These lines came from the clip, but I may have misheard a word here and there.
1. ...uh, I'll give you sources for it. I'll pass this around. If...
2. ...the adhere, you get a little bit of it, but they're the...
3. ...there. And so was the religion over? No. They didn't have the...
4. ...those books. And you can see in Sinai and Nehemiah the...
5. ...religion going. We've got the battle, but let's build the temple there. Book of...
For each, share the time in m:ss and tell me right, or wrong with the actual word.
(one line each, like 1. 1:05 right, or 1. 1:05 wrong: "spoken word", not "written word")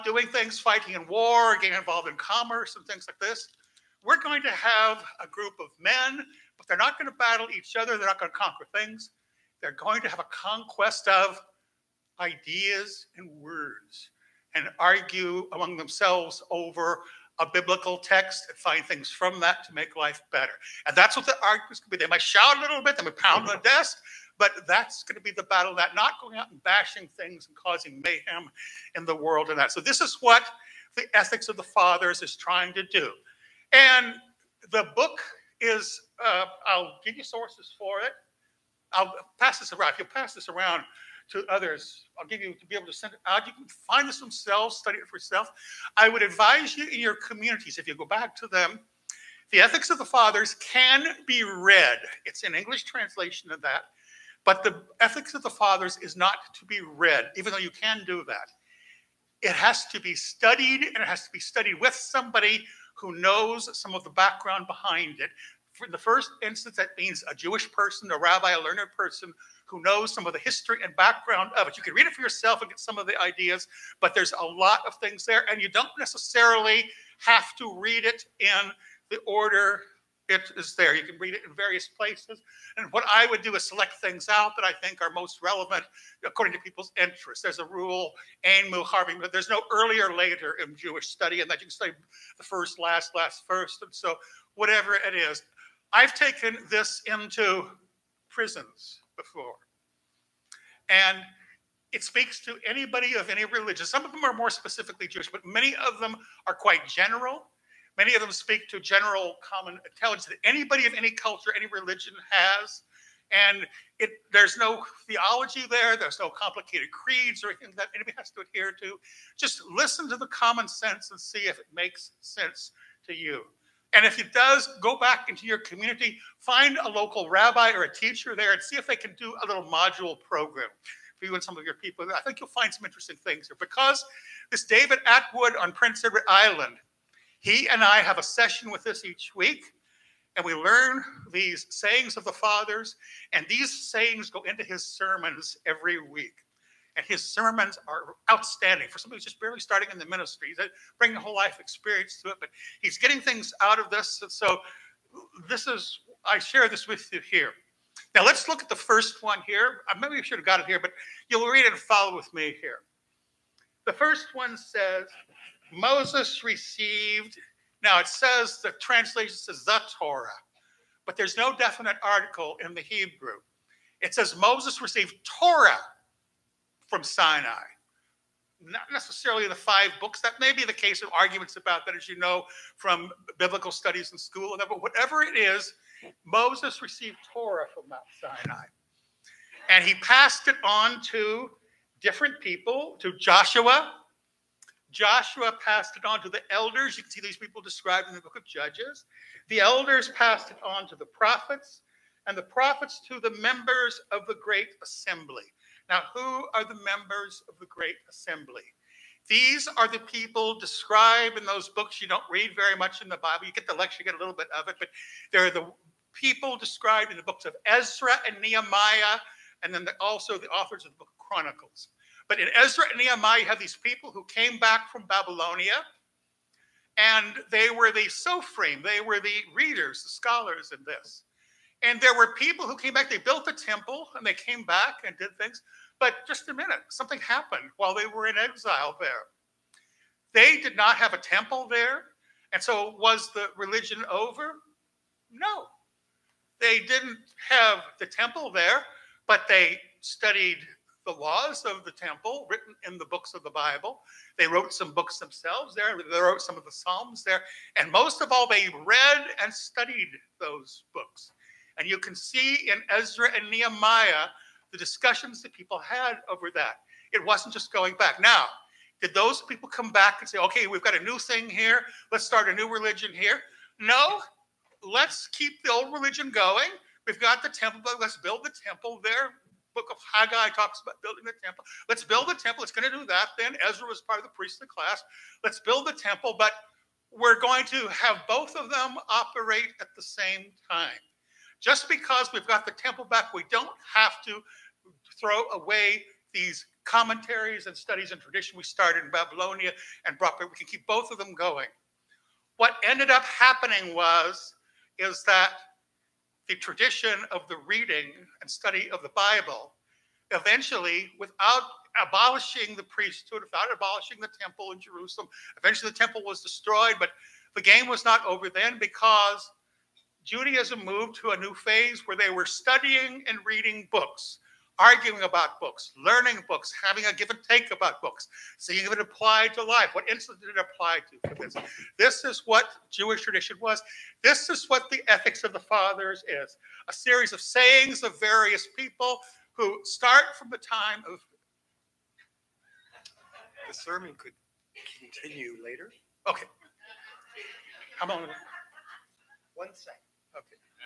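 1. 0:36 right
2. 3:33 wrong: "lecture", not "adhere"
3. 4:01 right
4. 4:20 wrong: "Ezra", not "Sinai"
5. 4:35 wrong: "temple", not "battle".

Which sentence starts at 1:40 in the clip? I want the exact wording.
And it speaks to anybody of any religion.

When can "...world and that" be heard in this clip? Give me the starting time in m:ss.
0:29.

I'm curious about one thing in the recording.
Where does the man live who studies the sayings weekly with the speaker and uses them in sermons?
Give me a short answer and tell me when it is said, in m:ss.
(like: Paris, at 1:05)
Prince Edward Island, at 2:15.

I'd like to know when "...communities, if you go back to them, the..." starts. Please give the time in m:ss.
0:47.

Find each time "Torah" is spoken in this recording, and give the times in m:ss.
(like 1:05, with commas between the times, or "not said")
2:49, 2:55, 3:07.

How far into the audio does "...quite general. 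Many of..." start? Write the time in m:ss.
1:46.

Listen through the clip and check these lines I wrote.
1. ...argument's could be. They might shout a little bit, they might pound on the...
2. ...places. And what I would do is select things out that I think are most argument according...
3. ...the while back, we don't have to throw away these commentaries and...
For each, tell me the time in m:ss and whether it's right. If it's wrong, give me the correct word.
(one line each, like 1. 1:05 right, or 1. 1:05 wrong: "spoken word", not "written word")
1. 0:21 right
2. 1:21 wrong: "relevant", not "argument"
3. 4:52 wrong: "temple", not "while".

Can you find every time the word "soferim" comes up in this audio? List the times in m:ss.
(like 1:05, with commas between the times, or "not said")
3:48.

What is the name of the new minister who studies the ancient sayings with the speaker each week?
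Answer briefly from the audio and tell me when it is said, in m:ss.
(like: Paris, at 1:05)
David Atwood, at 2:14.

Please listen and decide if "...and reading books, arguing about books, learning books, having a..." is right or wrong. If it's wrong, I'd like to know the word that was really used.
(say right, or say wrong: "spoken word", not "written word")
right.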